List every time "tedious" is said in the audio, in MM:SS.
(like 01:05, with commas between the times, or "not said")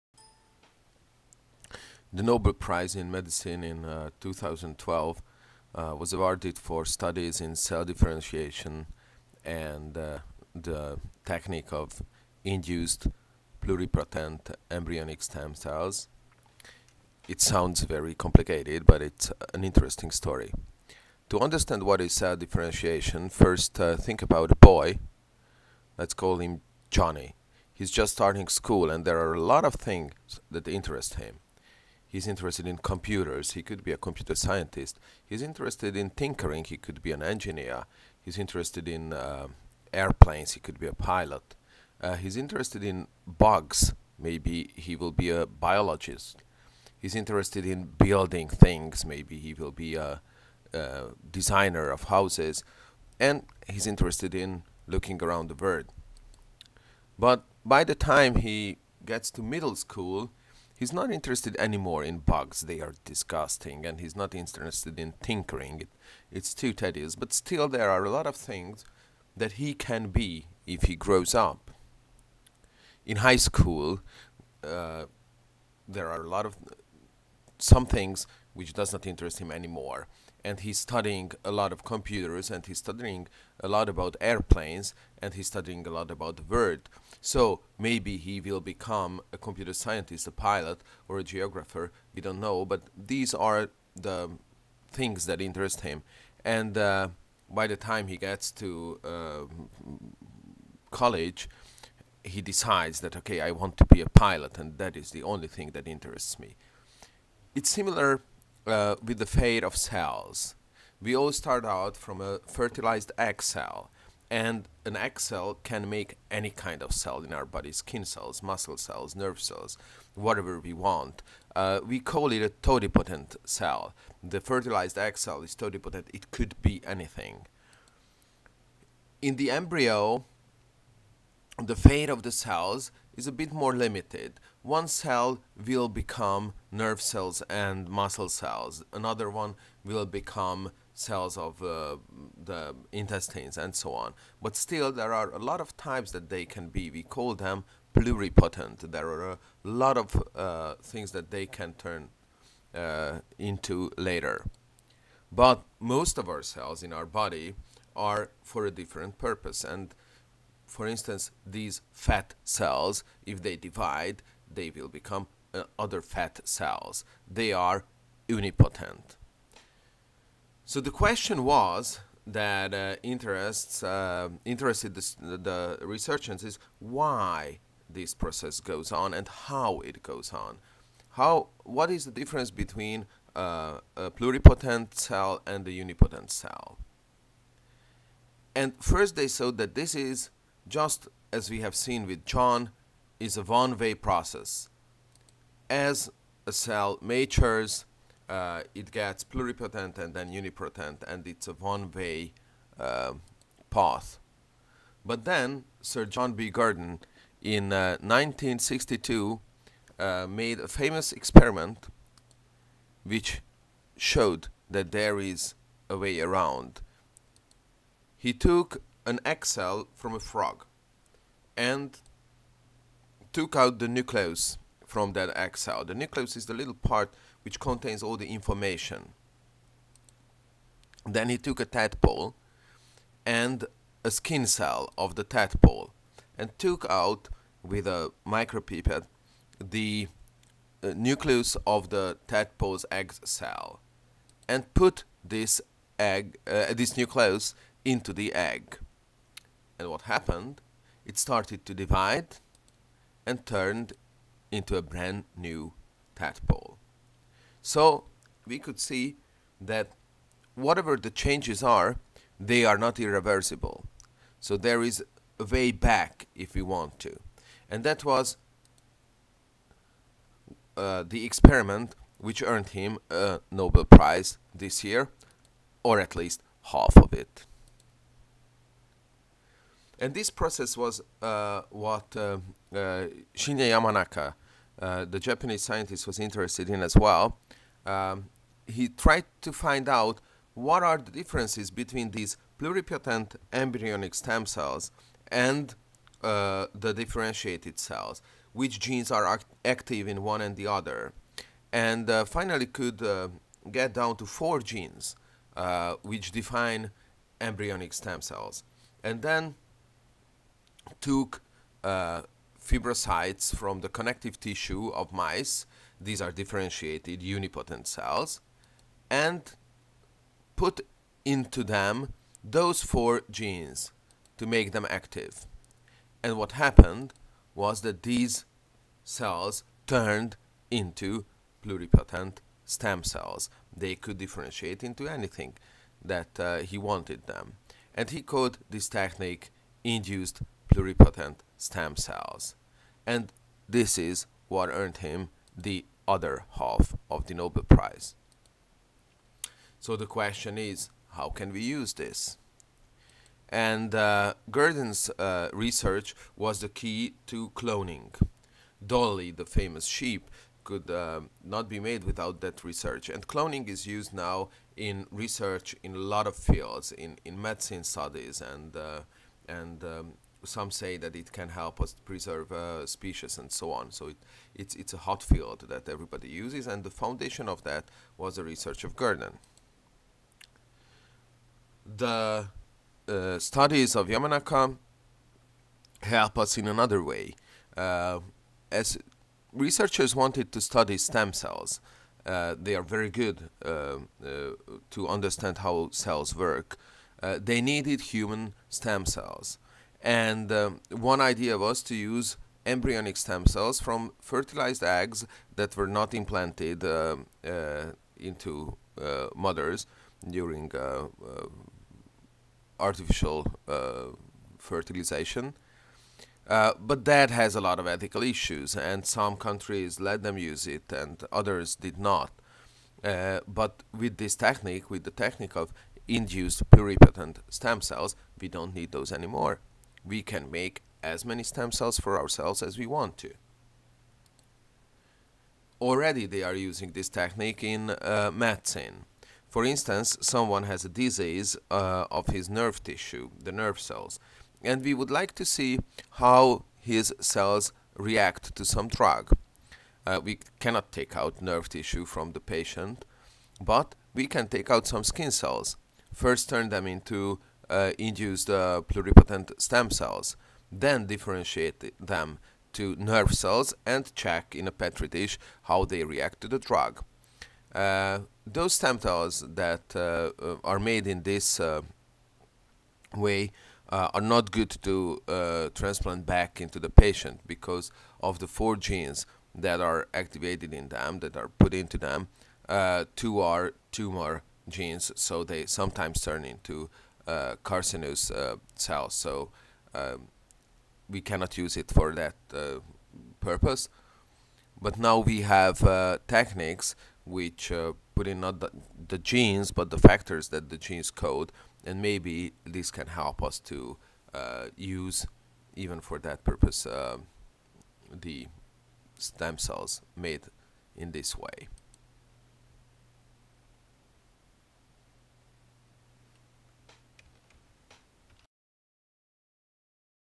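01:06.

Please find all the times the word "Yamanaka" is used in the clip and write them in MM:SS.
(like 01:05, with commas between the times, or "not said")
04:43, 06:24.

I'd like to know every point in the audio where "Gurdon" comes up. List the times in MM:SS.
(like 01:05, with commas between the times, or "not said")
03:26, 05:54, 06:18.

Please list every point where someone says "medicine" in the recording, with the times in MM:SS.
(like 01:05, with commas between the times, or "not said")
00:03, 06:07, 07:18.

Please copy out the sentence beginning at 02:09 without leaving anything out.
In the embryo, the fate of the cells is a bit more limited.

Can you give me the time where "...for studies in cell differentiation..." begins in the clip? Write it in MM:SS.
00:06.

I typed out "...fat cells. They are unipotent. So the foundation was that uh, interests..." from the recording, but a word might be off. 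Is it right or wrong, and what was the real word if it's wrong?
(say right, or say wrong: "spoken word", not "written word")
wrong: "question", not "foundation".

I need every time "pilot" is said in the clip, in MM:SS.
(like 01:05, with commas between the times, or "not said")
00:40, 01:30, 01:44.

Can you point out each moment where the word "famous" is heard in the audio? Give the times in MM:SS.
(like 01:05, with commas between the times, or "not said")
03:30, 05:59.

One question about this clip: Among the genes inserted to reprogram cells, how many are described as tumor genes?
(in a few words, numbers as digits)
2.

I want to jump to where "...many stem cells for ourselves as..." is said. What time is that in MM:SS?
07:11.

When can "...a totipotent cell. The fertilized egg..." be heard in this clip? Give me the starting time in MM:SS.
02:02.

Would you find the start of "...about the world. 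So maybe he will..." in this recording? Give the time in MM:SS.
01:26.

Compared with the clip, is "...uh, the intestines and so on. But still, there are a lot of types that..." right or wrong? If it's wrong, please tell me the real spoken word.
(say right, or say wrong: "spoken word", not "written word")
right.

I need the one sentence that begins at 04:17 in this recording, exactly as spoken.
So we could see that whatever the changes are, they are not irreversible.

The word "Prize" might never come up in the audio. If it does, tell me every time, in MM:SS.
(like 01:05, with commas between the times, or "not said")
00:02, 04:33, 05:47.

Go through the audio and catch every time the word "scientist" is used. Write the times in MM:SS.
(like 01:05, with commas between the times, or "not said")
00:34, 01:29, 04:45.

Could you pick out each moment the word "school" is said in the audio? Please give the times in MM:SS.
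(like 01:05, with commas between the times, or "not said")
00:28, 00:59, 01:13.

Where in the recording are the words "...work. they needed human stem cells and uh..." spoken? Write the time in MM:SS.
06:36.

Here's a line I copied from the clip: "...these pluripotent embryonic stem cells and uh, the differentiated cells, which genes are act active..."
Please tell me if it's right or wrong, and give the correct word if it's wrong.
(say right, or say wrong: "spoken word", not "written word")
right.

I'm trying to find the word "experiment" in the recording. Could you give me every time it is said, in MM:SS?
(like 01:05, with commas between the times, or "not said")
03:31, 04:31.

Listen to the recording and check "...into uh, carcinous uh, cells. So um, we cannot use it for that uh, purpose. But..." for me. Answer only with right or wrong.
right.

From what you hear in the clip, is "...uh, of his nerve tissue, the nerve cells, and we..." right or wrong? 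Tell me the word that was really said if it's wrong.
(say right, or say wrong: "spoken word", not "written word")
right.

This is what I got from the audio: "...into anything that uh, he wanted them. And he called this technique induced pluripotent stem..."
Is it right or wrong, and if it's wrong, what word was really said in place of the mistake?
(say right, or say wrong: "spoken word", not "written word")
right.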